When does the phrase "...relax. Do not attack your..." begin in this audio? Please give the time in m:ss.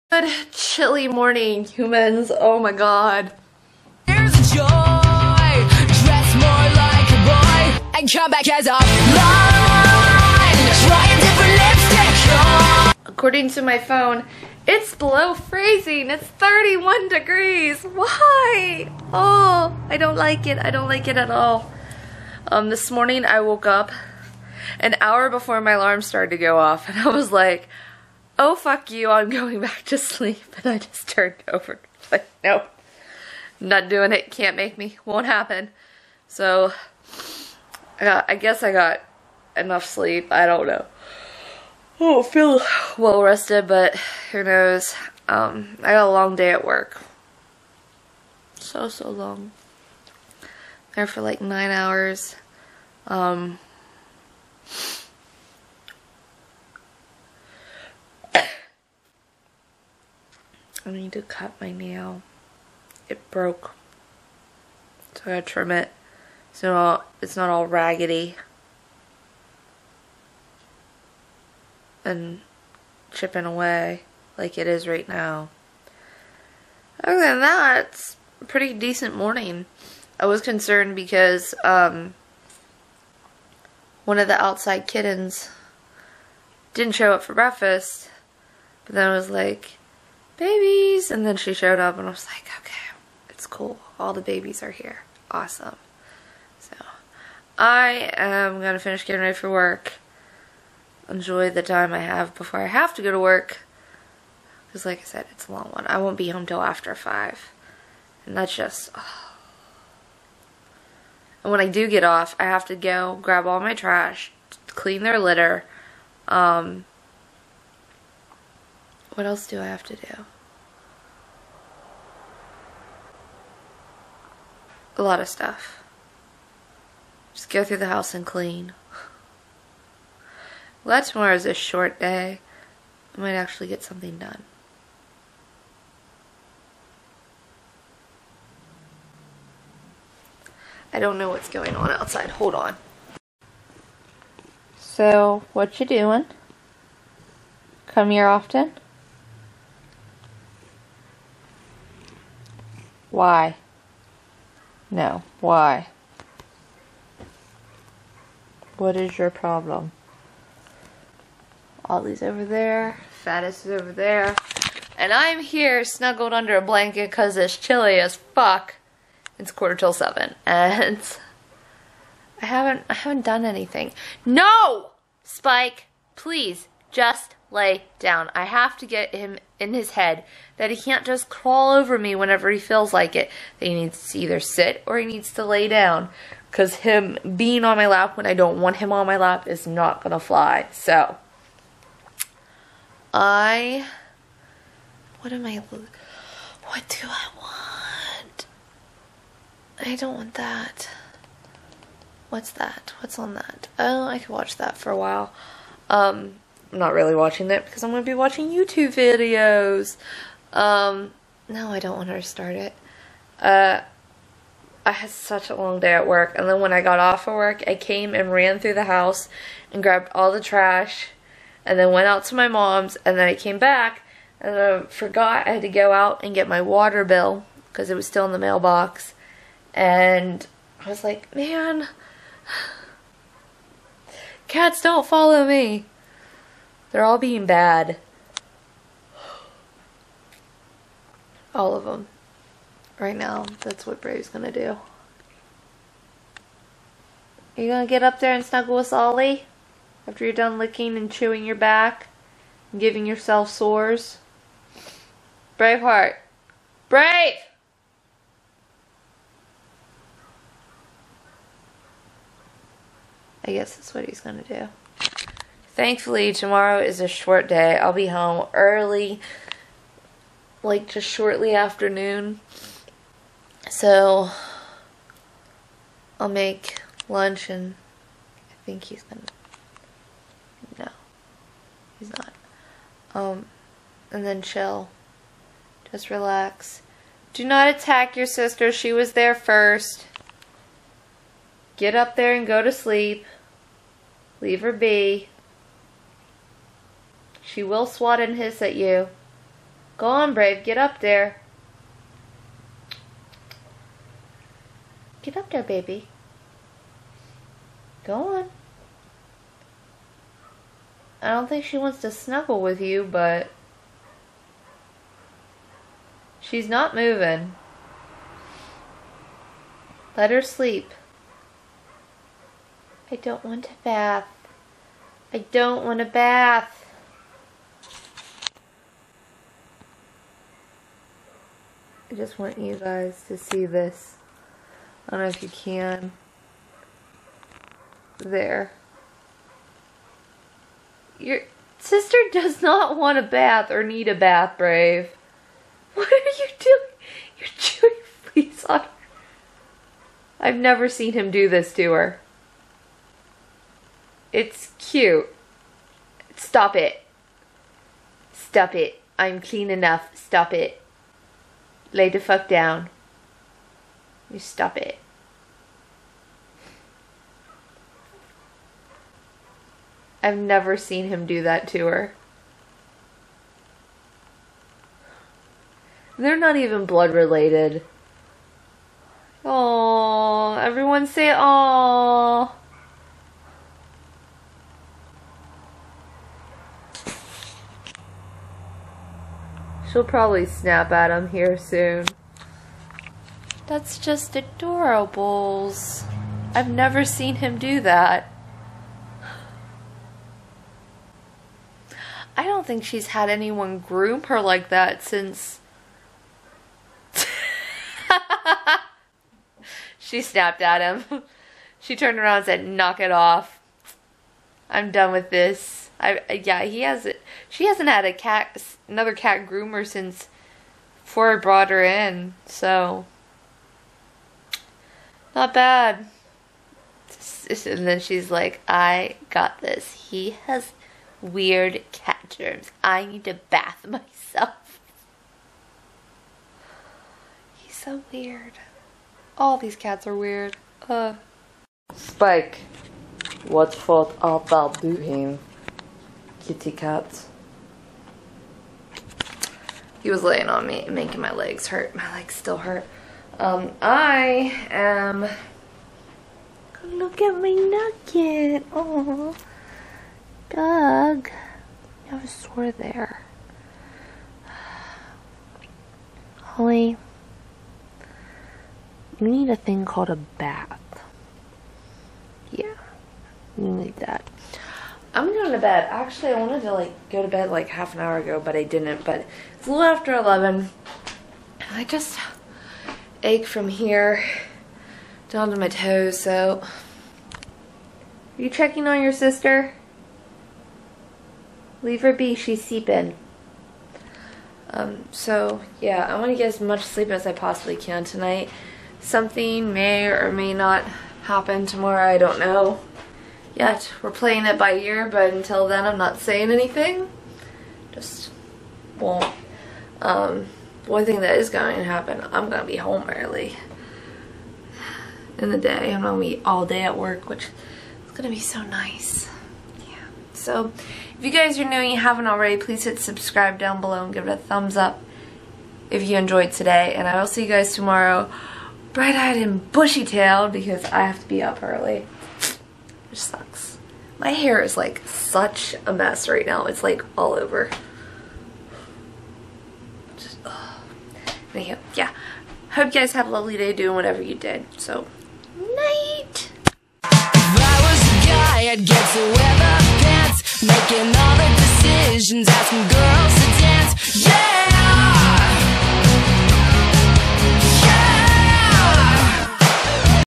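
4:46.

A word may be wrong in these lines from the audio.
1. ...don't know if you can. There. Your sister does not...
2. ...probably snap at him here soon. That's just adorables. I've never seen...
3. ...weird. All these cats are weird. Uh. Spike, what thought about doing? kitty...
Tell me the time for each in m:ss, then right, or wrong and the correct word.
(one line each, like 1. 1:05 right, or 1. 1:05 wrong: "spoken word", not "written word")
1. 5:35 right
2. 6:30 right
3. 7:18 right.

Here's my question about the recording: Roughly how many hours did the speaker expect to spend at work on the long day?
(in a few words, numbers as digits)
9.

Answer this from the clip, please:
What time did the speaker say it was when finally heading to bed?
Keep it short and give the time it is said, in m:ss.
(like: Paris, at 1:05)
A little after 11, at 7:59.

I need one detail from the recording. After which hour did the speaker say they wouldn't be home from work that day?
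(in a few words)
5.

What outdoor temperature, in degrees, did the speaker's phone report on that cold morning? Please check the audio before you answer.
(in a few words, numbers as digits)
31.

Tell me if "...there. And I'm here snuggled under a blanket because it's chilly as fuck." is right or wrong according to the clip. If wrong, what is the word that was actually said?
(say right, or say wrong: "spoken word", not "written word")
right.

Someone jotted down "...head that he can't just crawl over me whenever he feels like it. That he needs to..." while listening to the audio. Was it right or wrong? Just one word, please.
right.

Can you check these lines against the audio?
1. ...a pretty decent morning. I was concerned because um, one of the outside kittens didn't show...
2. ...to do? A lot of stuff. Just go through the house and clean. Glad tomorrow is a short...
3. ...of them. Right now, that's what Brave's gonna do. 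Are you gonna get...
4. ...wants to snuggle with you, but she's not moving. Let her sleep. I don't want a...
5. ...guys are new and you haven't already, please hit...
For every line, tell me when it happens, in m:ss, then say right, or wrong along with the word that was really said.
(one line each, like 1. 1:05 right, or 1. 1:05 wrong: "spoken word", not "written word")
1. 1:18 right
2. 1:59 right
3. 4:01 right
4. 5:11 right
5. 8:41 right.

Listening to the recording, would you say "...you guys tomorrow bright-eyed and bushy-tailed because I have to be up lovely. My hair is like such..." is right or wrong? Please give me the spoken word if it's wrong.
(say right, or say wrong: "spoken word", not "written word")
wrong: "early", not "lovely".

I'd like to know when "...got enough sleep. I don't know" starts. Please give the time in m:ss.
0:38.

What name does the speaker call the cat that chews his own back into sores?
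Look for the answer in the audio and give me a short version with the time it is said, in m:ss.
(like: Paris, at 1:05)
Braveheart, at 4:15.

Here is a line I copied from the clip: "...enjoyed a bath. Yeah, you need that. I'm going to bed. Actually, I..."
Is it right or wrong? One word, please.
wrong.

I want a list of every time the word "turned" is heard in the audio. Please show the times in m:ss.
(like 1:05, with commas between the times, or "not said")
0:31, 6:51.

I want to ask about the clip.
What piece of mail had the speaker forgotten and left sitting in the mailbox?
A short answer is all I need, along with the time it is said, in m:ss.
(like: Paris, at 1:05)
Water bill, at 3:46.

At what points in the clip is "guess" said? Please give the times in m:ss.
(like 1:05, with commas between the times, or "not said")
0:38, 4:23.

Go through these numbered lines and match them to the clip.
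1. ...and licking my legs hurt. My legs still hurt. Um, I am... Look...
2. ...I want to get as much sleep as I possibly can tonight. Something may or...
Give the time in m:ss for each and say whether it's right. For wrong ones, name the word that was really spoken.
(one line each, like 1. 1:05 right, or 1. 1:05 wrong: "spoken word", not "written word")
1. 7:30 wrong: "making", not "licking"
2. 8:16 right.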